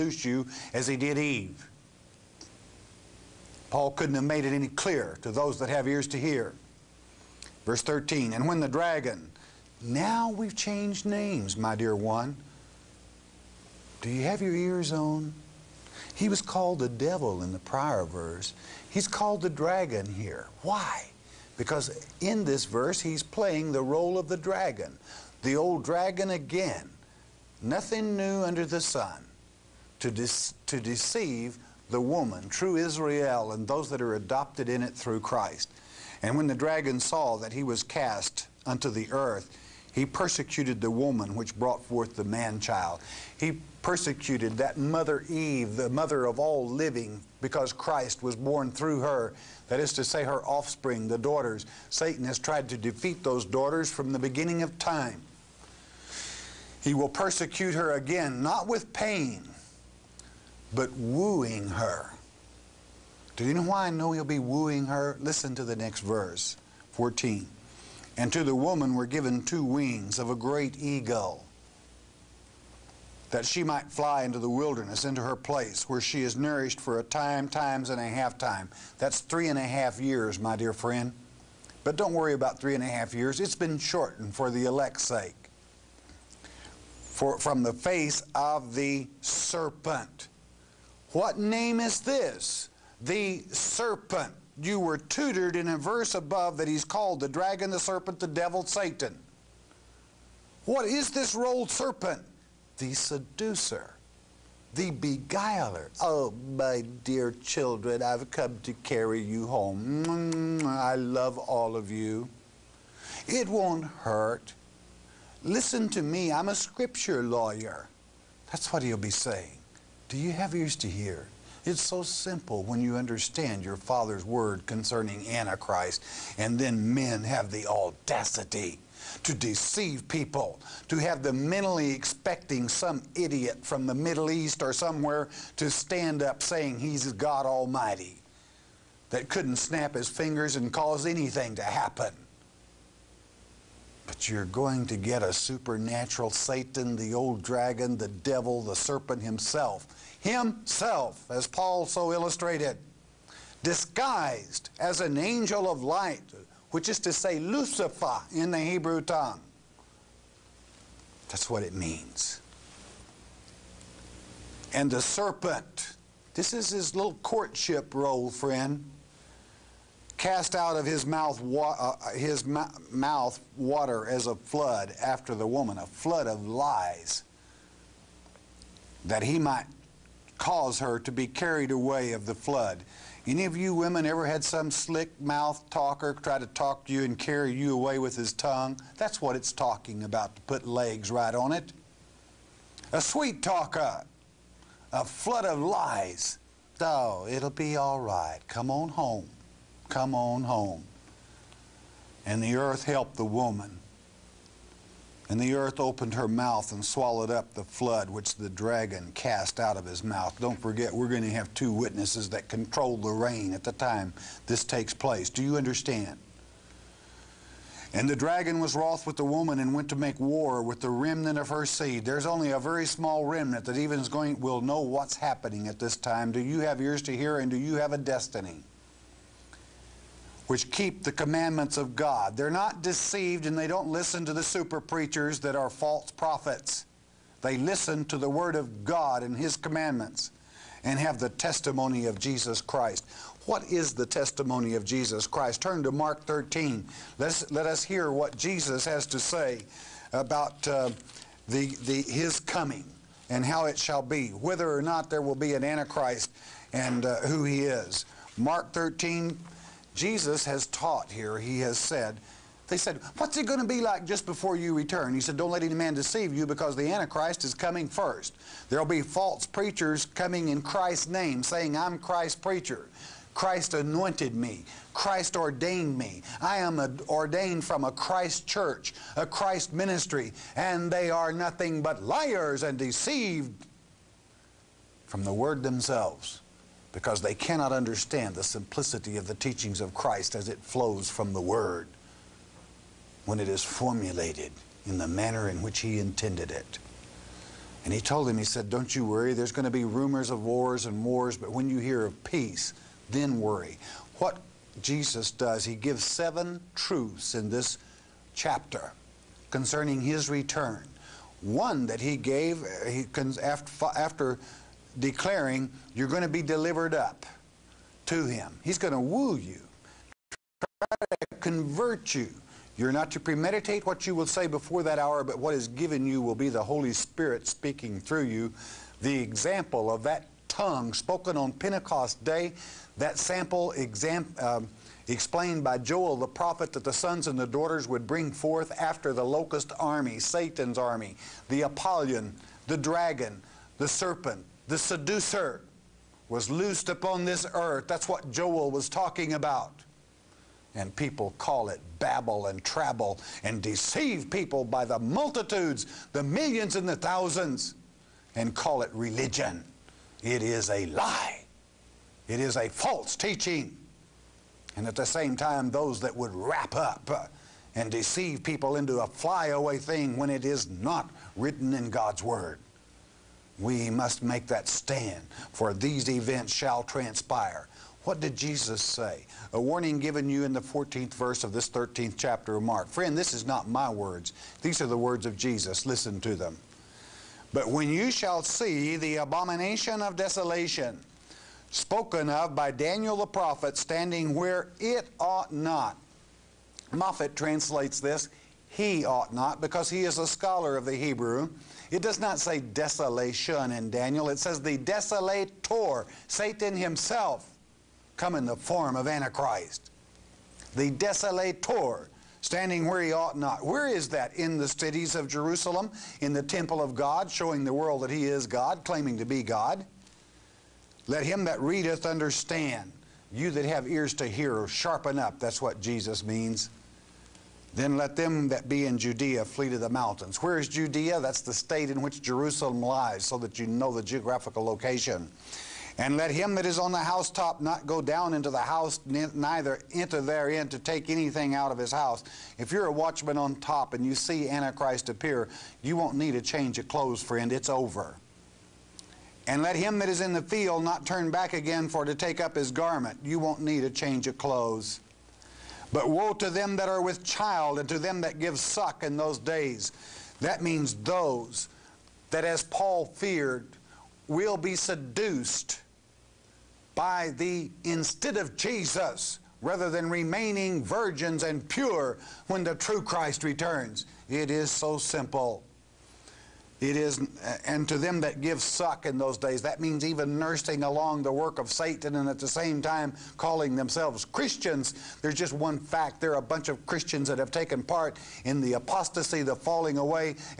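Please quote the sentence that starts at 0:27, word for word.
Nothing new under the sun to, de to deceive the woman, true Israel, and those that are adopted in it through Christ.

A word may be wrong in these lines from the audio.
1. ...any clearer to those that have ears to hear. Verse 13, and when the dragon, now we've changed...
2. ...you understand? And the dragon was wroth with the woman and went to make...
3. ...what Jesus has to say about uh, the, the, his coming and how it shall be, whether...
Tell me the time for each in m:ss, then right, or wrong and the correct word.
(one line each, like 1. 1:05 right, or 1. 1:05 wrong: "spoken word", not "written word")
1. 0:04 right
2. 3:35 right
3. 4:08 right.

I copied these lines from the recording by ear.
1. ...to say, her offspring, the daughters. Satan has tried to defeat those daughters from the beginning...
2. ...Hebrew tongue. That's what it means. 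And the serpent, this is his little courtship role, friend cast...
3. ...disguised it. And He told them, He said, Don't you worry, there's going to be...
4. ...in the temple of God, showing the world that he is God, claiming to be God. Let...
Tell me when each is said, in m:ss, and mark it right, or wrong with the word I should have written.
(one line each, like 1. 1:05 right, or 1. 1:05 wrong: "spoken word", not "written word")
1. 0:49 right
2. 2:38 right
3. 4:55 wrong: "intended", not "disguised"
4. 6:56 right.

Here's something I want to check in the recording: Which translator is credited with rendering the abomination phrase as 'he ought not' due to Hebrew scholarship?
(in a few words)
Moffatt.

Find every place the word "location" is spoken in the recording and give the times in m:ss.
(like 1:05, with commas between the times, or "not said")
7:14.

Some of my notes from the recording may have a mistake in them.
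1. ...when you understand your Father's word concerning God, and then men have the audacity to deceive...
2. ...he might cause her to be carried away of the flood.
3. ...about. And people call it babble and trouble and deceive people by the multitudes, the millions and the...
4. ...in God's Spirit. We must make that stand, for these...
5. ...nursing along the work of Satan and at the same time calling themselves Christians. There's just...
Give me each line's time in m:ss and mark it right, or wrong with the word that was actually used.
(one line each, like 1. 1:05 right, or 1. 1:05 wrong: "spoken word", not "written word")
1. 2:02 wrong: "Antichrist", not "God"
2. 2:59 right
3. 5:49 right
4. 6:11 wrong: "Word", not "Spirit"
5. 8:00 right.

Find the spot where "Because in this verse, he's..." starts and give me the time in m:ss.
0:21.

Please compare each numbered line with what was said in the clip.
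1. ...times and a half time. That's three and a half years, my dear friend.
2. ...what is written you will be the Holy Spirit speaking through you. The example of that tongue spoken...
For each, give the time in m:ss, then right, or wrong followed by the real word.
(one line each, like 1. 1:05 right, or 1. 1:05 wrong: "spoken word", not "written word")
1. 1:17 right
2. 5:25 wrong: "given", not "written".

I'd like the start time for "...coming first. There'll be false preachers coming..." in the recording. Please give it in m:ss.
4:27.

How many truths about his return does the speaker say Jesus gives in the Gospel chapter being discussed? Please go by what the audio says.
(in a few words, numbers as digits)
7.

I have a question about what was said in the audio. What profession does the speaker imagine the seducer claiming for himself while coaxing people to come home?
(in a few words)
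scripture lawyer.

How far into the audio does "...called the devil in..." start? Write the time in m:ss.
0:16.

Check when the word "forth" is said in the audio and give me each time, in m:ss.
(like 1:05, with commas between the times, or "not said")
0:41, 5:38.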